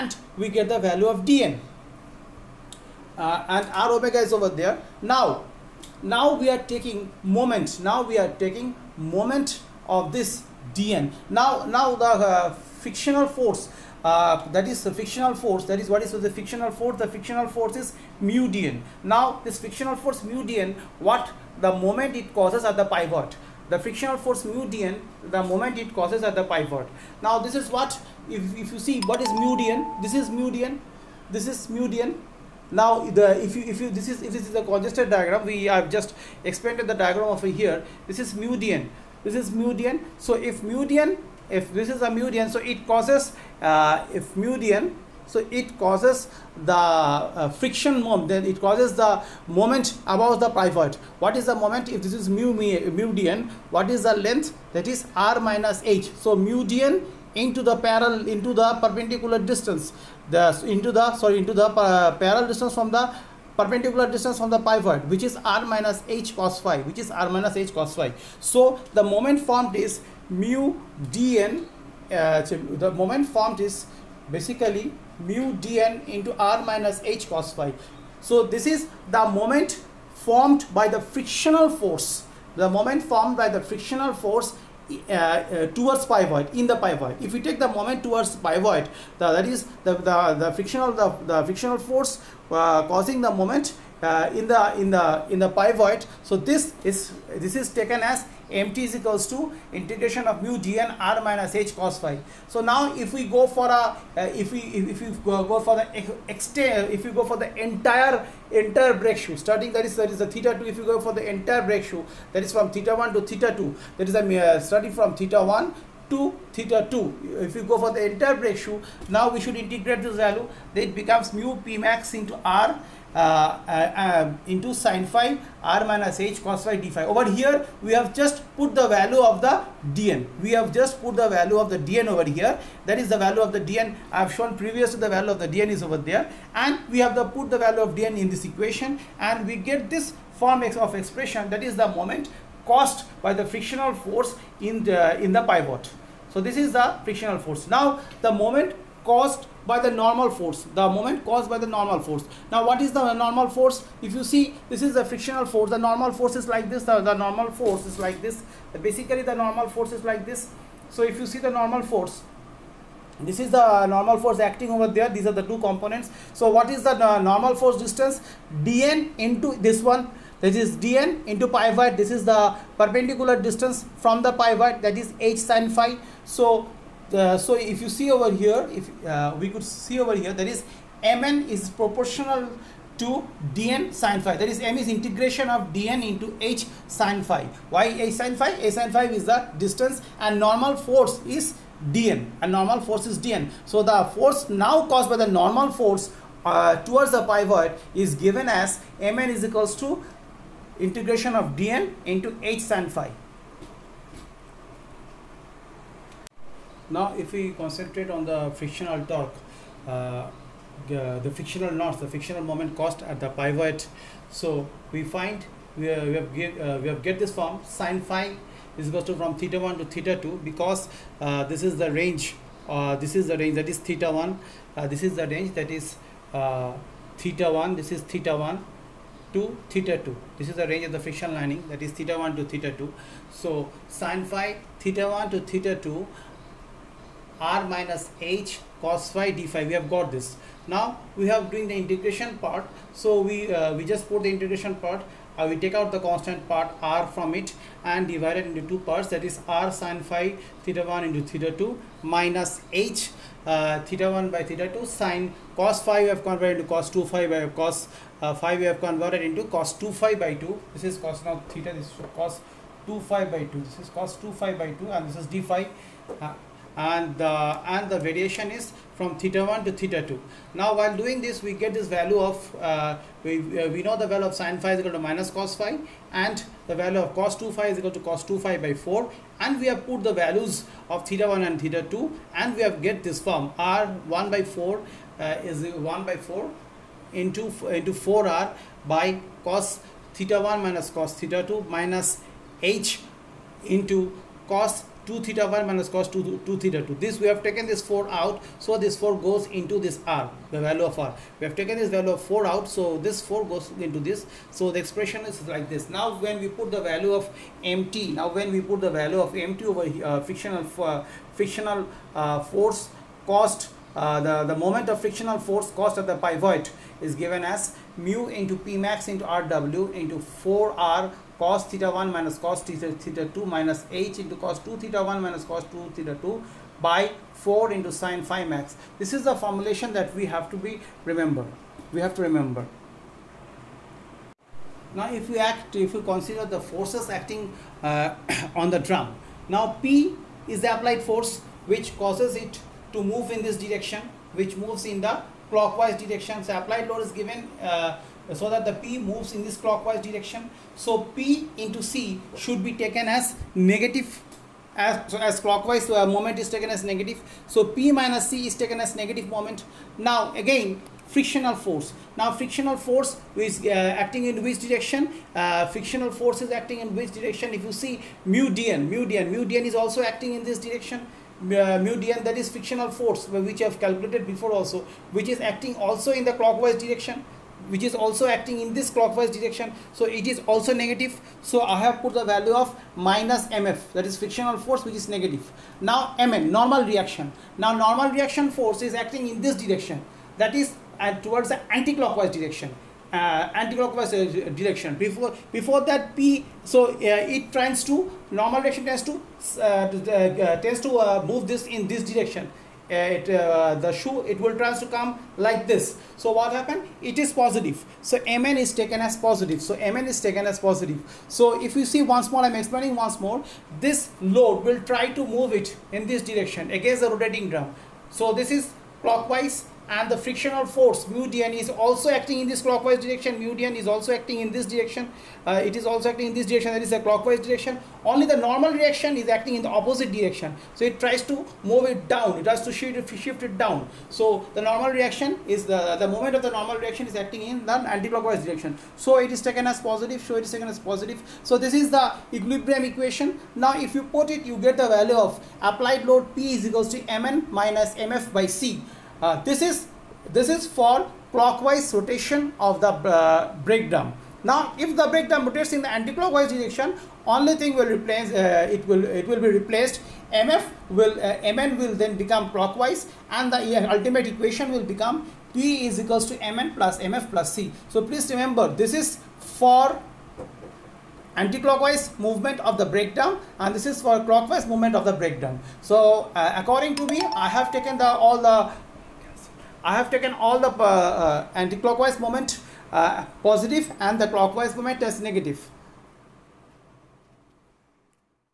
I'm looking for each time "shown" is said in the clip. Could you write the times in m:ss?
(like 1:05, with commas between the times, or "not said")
2:14.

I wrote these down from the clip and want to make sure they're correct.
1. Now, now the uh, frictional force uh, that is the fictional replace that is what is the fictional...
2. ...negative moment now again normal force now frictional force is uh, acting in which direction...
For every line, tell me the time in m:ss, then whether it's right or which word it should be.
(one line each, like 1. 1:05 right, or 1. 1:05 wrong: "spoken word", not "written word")
1. 0:11 wrong: "force", not "replace"
2. 5:58 wrong: "frictional", not "normal".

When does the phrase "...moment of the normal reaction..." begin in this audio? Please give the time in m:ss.
7:16.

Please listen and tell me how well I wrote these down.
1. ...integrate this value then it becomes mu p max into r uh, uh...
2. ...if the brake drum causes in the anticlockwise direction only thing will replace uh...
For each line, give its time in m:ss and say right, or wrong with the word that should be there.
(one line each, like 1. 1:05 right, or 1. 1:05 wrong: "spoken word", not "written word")
1. 1:59 right
2. 7:34 wrong: "rotates", not "causes".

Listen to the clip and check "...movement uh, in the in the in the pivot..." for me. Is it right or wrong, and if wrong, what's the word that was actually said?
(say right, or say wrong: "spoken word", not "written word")
wrong: "moment", not "movement".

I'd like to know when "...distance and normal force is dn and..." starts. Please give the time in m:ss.
3:09.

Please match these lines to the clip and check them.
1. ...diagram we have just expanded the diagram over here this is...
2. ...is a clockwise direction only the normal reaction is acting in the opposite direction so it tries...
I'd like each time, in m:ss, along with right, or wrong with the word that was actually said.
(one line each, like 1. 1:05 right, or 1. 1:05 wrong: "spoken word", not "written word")
1. 0:35 right
2. 7:06 right.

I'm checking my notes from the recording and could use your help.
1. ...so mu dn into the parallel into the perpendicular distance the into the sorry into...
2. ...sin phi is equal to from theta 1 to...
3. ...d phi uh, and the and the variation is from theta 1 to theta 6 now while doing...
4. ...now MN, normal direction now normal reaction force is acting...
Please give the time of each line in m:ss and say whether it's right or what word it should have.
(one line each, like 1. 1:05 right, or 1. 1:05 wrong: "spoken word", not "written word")
1. 0:56 right
2. 3:37 right
3. 4:25 wrong: "2", not "6"
4. 6:25 wrong: "reaction", not "direction".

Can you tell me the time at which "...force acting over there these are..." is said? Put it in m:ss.
2:44.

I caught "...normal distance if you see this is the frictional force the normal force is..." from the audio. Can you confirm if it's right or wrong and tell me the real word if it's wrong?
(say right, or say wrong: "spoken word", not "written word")
wrong: "force", not "distance".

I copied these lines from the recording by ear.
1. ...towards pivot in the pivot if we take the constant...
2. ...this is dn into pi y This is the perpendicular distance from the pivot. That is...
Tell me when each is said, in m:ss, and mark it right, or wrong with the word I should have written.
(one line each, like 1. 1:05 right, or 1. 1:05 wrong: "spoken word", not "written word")
1. 1:25 wrong: "moment", not "constant"
2. 2:50 right.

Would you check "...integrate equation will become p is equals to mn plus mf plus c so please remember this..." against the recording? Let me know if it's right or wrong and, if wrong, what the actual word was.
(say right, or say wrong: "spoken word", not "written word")
wrong: "ultimate", not "integrate".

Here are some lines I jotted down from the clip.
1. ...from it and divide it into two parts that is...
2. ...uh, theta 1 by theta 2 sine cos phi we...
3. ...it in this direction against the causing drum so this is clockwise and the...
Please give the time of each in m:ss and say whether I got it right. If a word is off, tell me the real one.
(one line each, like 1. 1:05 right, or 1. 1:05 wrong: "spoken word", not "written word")
1. 4:07 right
2. 4:13 right
3. 6:55 wrong: "rotating", not "causing".